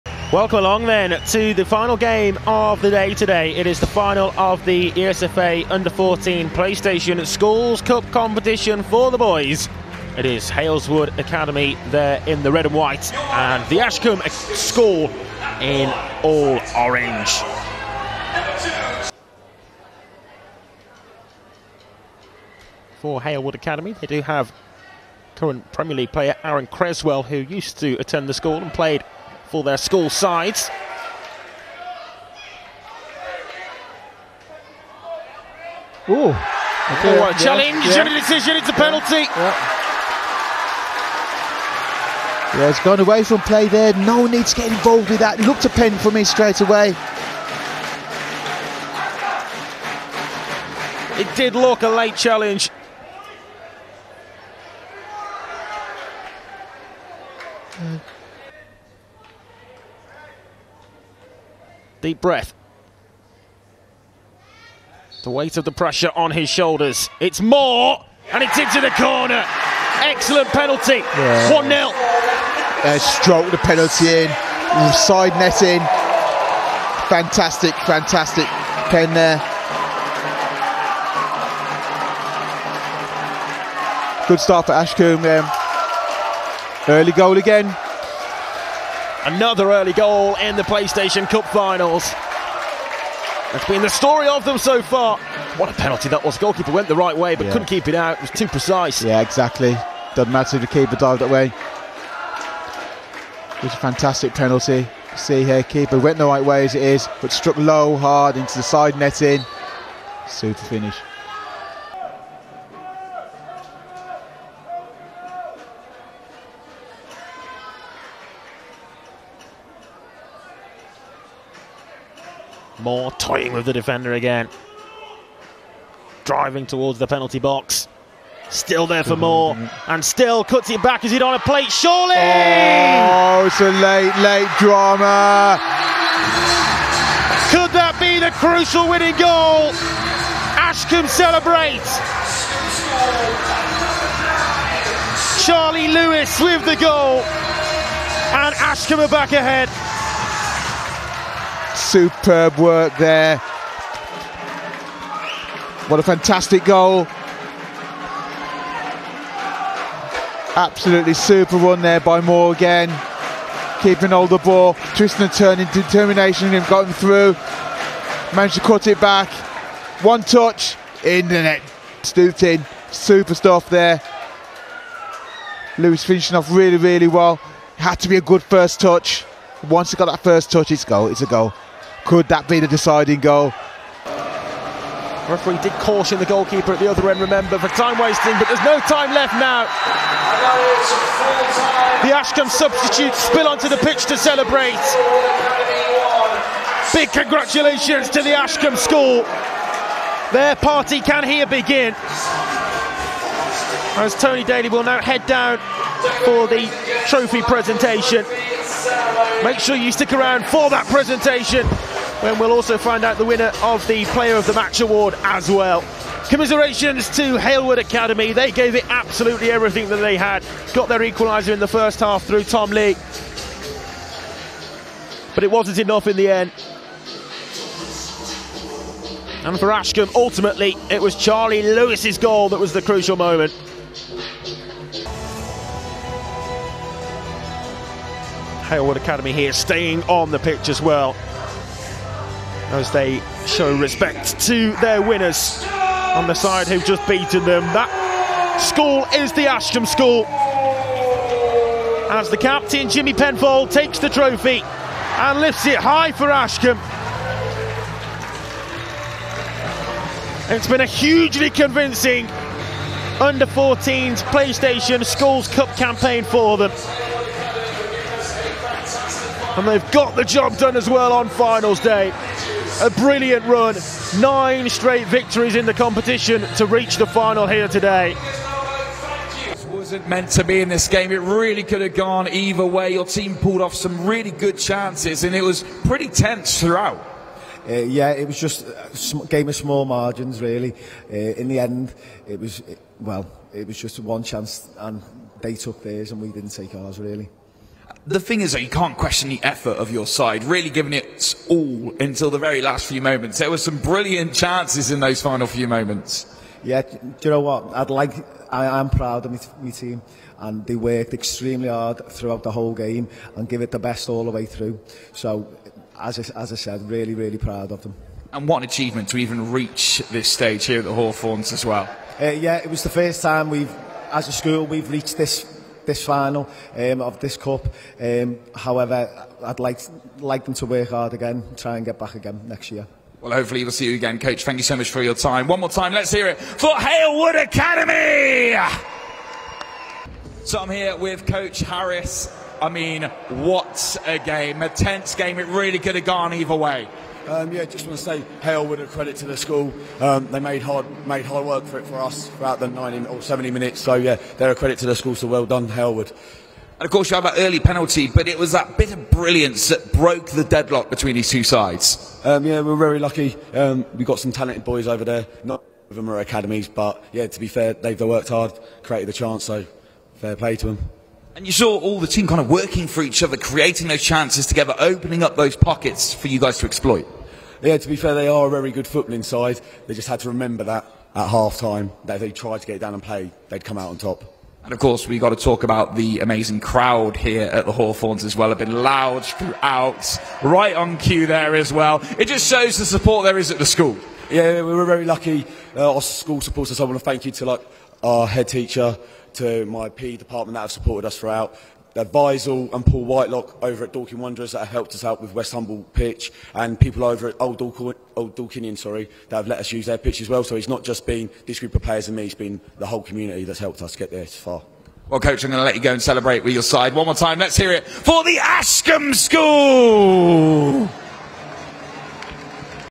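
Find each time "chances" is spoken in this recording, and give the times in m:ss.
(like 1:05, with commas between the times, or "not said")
4:44, 4:54, 5:04, 6:09, 6:14.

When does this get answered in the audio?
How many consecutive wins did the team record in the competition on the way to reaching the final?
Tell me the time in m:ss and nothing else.
4:34.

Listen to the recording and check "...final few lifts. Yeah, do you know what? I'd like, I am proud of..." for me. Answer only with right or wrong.
wrong.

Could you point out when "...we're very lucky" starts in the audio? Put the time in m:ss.
6:02.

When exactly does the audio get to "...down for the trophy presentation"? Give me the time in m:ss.
3:25.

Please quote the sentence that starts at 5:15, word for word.
So, as I, as I said, really, really proud of them.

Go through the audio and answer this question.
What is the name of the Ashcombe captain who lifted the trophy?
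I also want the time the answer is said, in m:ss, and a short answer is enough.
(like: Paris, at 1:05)
Jimmy Penfold, at 4:12.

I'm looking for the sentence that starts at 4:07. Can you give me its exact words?
That school is the Ashcombe School.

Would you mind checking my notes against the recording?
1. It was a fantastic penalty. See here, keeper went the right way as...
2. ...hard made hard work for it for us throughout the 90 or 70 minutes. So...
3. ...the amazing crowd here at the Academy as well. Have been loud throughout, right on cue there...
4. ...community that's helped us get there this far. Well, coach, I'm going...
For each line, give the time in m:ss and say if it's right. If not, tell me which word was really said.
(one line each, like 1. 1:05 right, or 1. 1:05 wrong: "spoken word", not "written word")
1. 1:43 right
2. 5:50 right
3. 6:25 wrong: "Hawthorns", not "Academy"
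4. 6:53 right.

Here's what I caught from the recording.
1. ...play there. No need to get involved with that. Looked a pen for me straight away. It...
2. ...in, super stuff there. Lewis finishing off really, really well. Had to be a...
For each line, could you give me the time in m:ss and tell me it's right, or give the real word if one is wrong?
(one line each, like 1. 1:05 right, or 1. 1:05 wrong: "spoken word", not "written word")
1. 0:43 right
2. 2:52 right.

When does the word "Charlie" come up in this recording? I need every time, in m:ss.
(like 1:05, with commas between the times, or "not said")
2:25, 3:51.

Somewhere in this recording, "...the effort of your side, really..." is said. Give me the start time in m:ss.
4:59.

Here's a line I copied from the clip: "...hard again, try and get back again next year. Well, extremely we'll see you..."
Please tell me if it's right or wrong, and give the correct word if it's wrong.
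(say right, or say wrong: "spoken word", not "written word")
wrong: "hopefully", not "extremely".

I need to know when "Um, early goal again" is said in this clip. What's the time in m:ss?
1:25.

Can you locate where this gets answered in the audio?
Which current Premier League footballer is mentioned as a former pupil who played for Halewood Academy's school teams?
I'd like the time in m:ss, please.
0:26.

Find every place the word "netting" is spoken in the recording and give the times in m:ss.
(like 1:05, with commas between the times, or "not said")
1:15, 1:48.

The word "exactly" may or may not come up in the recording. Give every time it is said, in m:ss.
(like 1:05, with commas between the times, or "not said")
1:39.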